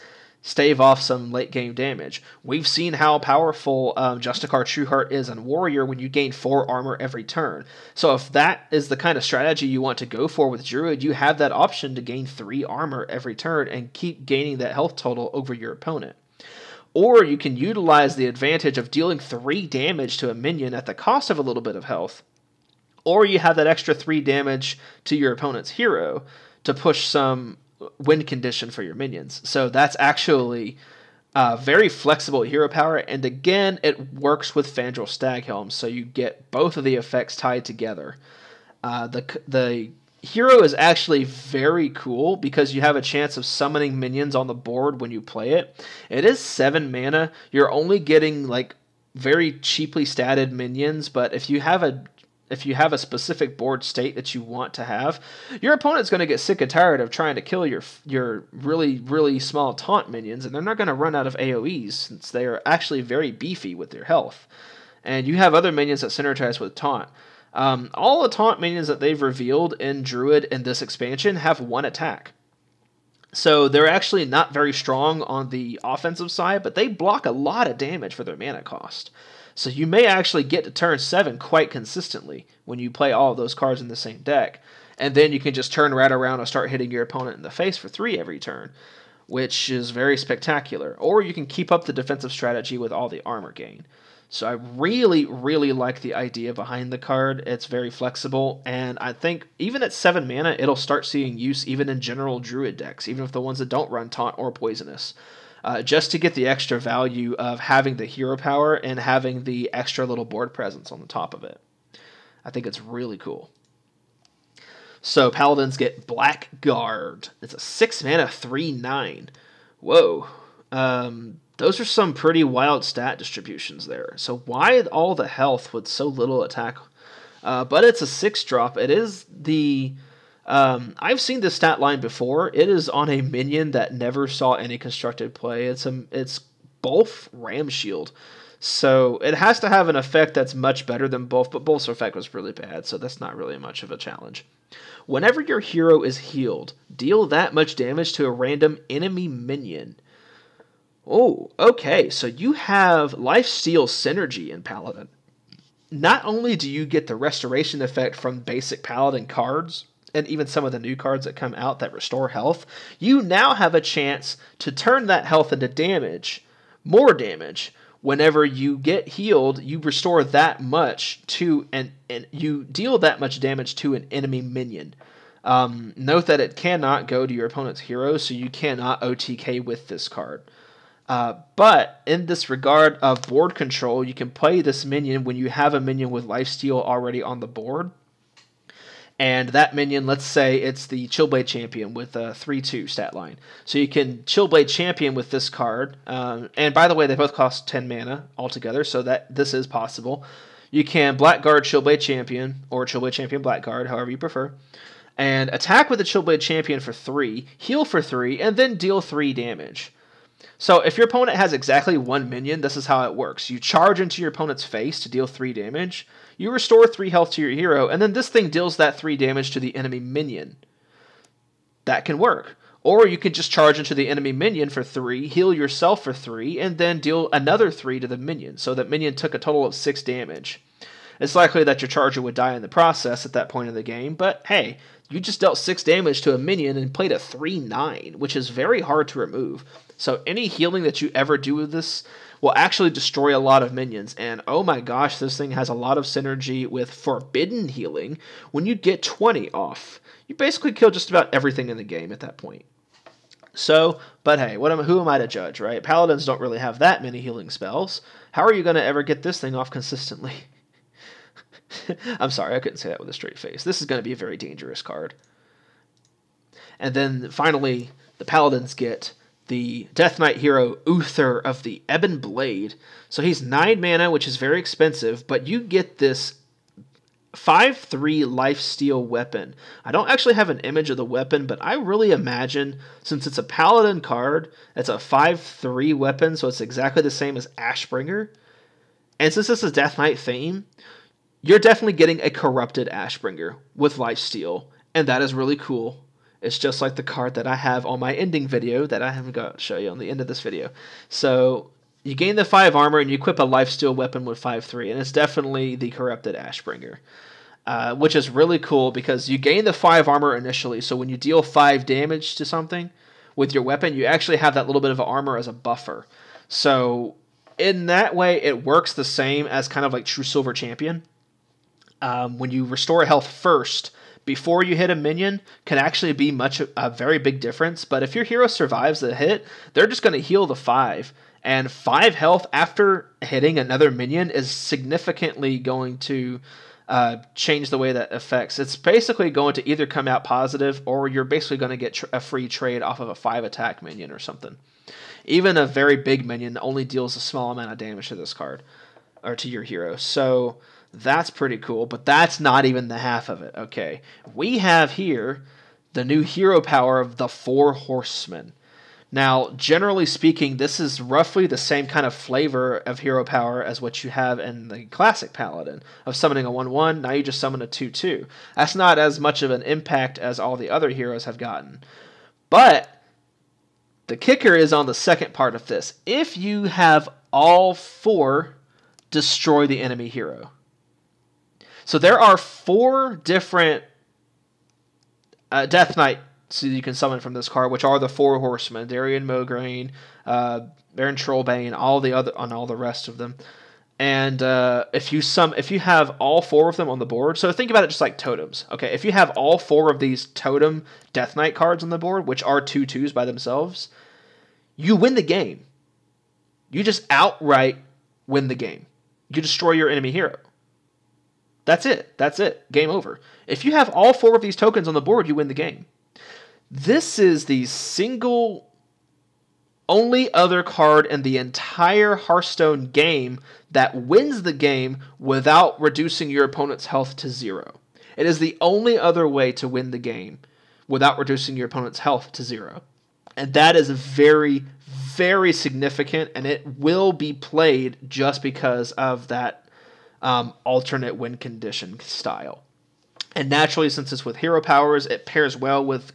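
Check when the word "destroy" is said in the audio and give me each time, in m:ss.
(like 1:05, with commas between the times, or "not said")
4:02, 6:19, 6:49.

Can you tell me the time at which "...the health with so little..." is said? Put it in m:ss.
2:05.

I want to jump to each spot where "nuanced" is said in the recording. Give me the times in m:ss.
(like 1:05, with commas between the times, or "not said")
not said.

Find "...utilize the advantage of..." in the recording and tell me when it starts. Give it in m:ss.
0:17.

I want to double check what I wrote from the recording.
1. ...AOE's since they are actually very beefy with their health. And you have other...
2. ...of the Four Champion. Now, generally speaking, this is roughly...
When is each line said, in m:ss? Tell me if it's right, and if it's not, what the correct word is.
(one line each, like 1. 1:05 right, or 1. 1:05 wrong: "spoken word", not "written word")
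1. 1:01 right
2. 5:57 wrong: "Horsemen", not "Champion".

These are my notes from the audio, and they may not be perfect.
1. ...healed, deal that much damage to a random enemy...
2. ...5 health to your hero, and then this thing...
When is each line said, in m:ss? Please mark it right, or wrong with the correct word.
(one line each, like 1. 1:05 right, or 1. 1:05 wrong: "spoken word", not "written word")
1. 2:26 right
2. 3:36 wrong: "3", not "5".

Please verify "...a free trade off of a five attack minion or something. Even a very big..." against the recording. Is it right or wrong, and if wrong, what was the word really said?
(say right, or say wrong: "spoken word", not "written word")
right.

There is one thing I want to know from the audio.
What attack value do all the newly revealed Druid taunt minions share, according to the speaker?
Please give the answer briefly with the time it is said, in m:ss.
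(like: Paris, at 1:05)
1, at 1:11.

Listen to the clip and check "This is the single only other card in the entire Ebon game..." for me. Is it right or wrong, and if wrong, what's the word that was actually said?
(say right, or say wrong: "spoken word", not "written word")
wrong: "Hearthstone", not "Ebon".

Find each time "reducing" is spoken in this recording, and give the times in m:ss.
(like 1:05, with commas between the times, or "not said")
7:05, 7:11.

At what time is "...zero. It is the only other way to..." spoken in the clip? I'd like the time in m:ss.
7:07.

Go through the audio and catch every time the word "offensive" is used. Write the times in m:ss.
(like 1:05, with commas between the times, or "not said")
1:15.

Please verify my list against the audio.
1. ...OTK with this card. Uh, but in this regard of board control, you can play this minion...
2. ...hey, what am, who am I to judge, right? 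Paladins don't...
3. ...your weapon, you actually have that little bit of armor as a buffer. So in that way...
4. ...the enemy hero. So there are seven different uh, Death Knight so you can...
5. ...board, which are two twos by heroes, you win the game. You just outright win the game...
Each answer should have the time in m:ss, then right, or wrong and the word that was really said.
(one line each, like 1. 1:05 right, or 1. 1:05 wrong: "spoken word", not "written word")
1. 2:59 right
2. 4:14 right
3. 5:13 right
4. 6:19 wrong: "four", not "seven"
5. 6:41 wrong: "themselves", not "heroes".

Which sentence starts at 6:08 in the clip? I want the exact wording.
That's not as much of an impact as all the other heroes have gotten.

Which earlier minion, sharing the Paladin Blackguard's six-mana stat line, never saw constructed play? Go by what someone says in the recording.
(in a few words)
Bolf Ramshield.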